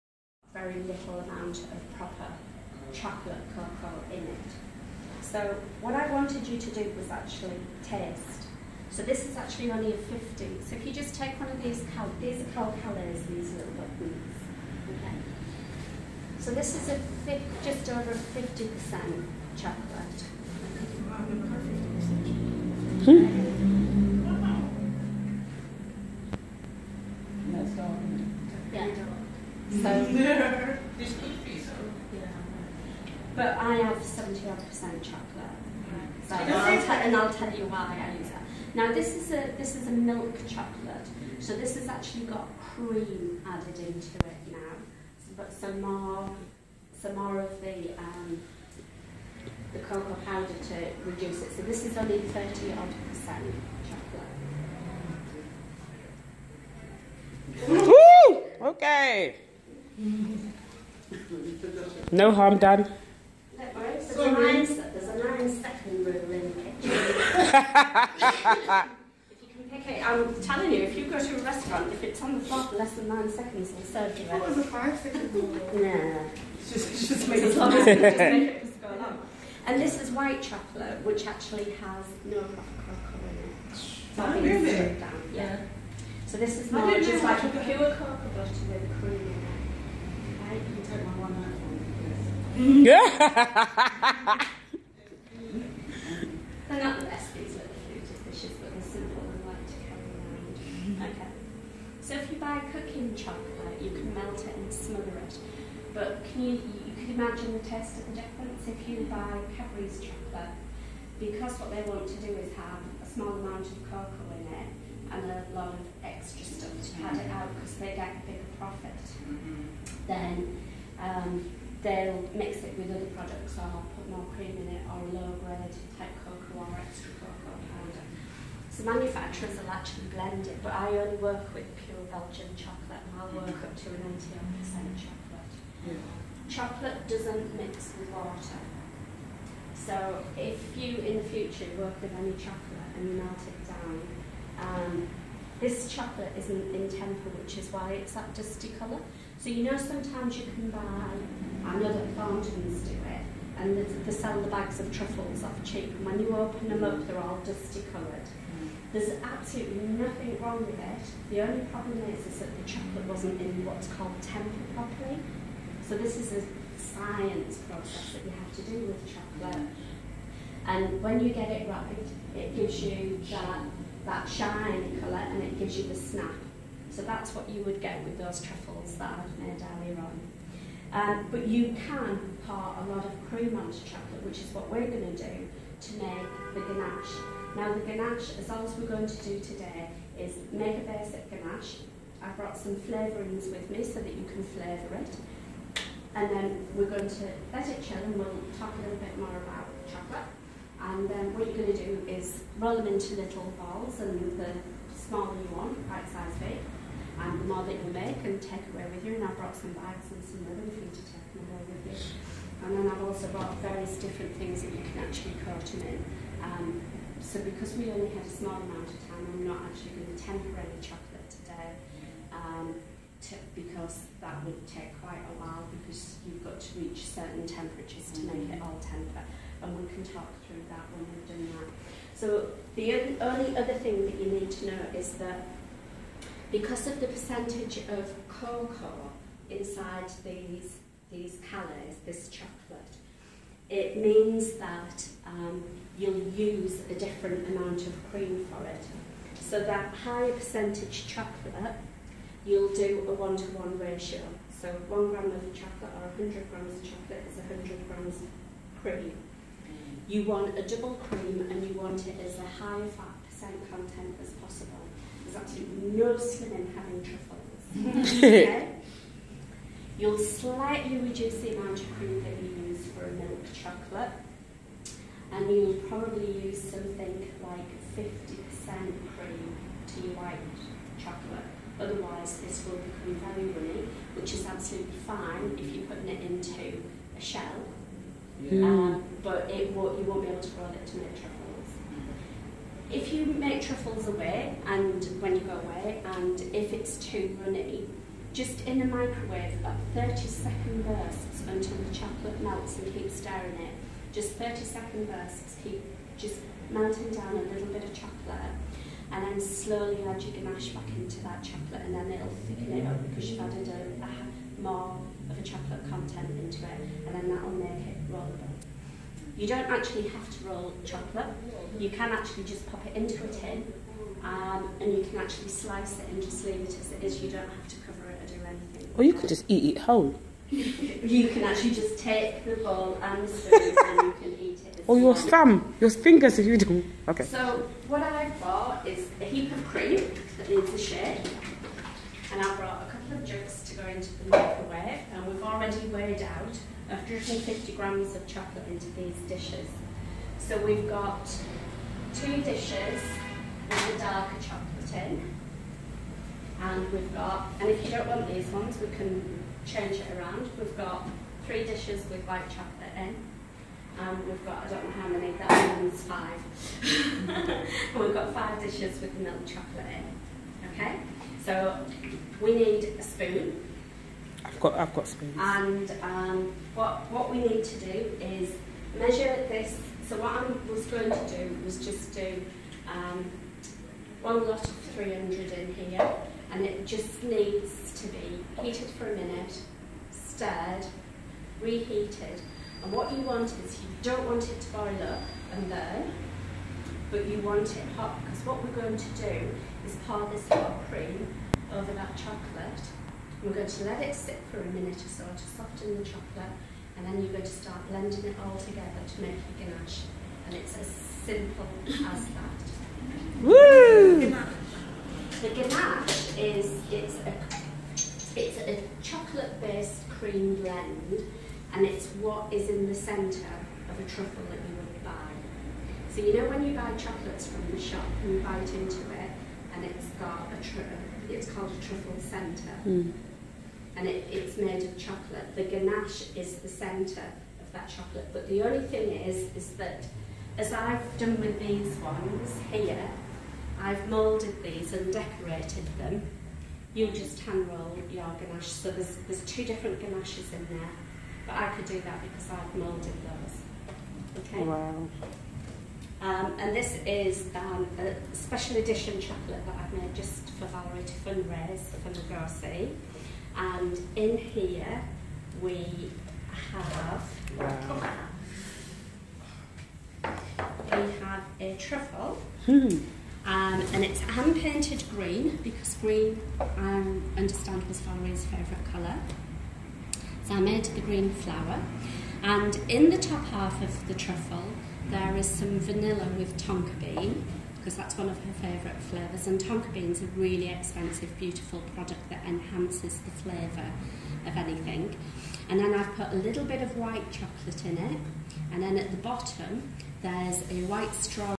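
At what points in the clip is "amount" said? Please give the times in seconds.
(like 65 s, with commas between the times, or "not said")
1 s, 113 s, 218 s, 247 s, 271 s.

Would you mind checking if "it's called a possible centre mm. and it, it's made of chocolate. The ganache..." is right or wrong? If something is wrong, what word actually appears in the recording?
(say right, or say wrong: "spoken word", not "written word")
wrong: "truffle", not "possible".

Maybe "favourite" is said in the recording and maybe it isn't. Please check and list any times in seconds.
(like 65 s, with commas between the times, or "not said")
478 s, 488 s.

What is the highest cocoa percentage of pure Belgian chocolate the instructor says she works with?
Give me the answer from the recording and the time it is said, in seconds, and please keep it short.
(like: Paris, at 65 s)
88%, at 134 s.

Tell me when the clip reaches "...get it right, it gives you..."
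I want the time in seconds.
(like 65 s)
171 s.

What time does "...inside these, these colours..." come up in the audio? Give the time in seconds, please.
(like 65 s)
239 s.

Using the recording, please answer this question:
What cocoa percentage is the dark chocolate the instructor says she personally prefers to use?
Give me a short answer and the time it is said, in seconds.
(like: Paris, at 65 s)
75%, at 34 s.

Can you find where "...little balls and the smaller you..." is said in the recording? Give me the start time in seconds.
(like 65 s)
203 s.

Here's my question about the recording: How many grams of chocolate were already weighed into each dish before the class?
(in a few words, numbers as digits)
150 grams.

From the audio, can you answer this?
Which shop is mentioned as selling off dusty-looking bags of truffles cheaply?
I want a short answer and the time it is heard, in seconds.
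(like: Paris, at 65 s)
Thorntons, at 152 s.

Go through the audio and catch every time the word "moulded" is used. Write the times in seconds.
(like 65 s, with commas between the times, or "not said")
444 s, 452 s.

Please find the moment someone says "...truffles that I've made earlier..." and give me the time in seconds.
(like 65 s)
178 s.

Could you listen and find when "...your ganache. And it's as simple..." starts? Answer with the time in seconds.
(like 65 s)
409 s.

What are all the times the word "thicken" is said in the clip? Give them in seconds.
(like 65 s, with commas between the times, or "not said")
312 s.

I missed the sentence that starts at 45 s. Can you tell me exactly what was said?
So, but some more some more of the um, the cocoa powder to reduce it.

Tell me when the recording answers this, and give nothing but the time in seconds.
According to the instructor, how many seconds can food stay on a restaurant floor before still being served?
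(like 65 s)
73 s.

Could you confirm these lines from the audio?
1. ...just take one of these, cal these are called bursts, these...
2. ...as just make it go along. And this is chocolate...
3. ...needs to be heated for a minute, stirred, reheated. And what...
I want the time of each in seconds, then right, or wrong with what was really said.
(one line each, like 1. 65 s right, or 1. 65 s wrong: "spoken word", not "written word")
1. 10 s wrong: "callets", not "bursts"
2. 77 s wrong: "white", not "chocolate"
3. 387 s right.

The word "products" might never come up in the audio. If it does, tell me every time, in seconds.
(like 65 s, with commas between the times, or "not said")
123 s, 491 s.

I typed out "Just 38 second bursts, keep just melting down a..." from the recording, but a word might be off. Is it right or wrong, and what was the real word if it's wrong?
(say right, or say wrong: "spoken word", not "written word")
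wrong: "30", not "38".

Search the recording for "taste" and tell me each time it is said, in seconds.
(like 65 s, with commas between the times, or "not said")
7 s, 107 s.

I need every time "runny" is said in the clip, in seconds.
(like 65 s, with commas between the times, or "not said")
283 s, 297 s.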